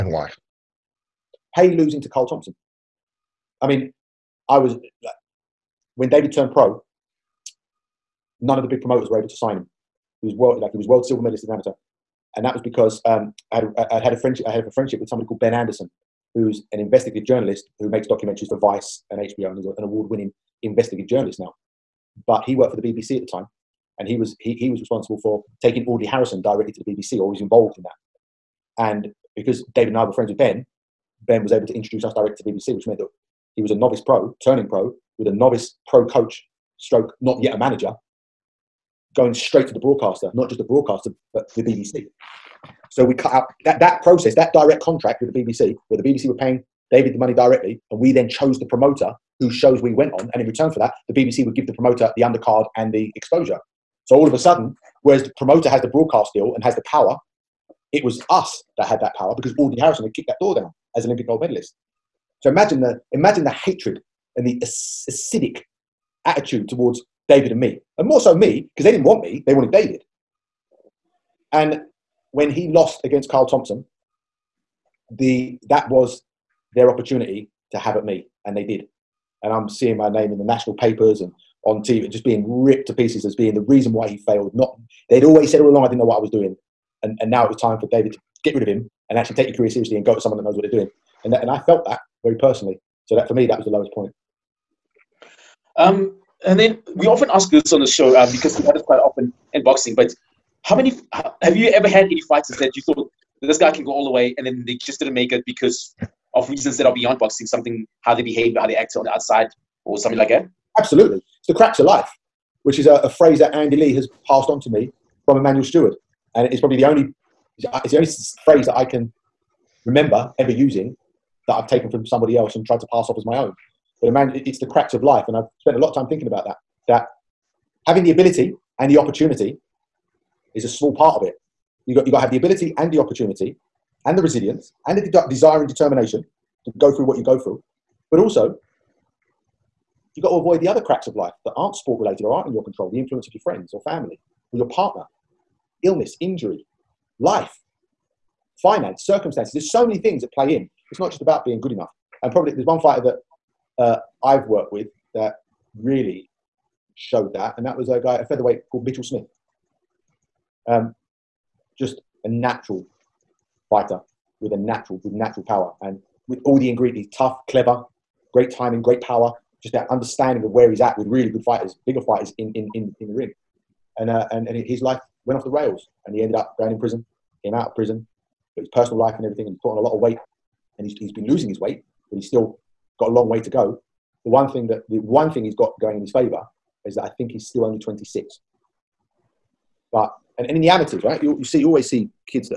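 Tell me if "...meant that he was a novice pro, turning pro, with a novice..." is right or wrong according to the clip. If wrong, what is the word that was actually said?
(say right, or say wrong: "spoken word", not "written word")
right.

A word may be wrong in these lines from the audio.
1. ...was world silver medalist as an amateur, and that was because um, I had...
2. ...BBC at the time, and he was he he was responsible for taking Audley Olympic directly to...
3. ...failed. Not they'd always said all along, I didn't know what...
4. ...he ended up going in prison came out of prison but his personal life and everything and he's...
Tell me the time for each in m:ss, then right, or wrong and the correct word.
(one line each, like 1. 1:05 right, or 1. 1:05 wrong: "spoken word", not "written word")
1. 0:10 right
2. 0:22 wrong: "Harrison", not "Olympic"
3. 1:24 right
4. 2:56 right.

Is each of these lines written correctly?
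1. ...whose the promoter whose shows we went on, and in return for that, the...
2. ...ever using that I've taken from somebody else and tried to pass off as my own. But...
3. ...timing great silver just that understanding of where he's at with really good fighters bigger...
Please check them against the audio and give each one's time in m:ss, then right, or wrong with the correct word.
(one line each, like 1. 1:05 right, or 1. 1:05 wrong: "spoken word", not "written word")
1. 0:48 wrong: "chose", not "whose"
2. 2:00 right
3. 2:48 wrong: "power", not "silver".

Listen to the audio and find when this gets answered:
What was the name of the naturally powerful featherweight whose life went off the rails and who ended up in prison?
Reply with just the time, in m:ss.
2:38.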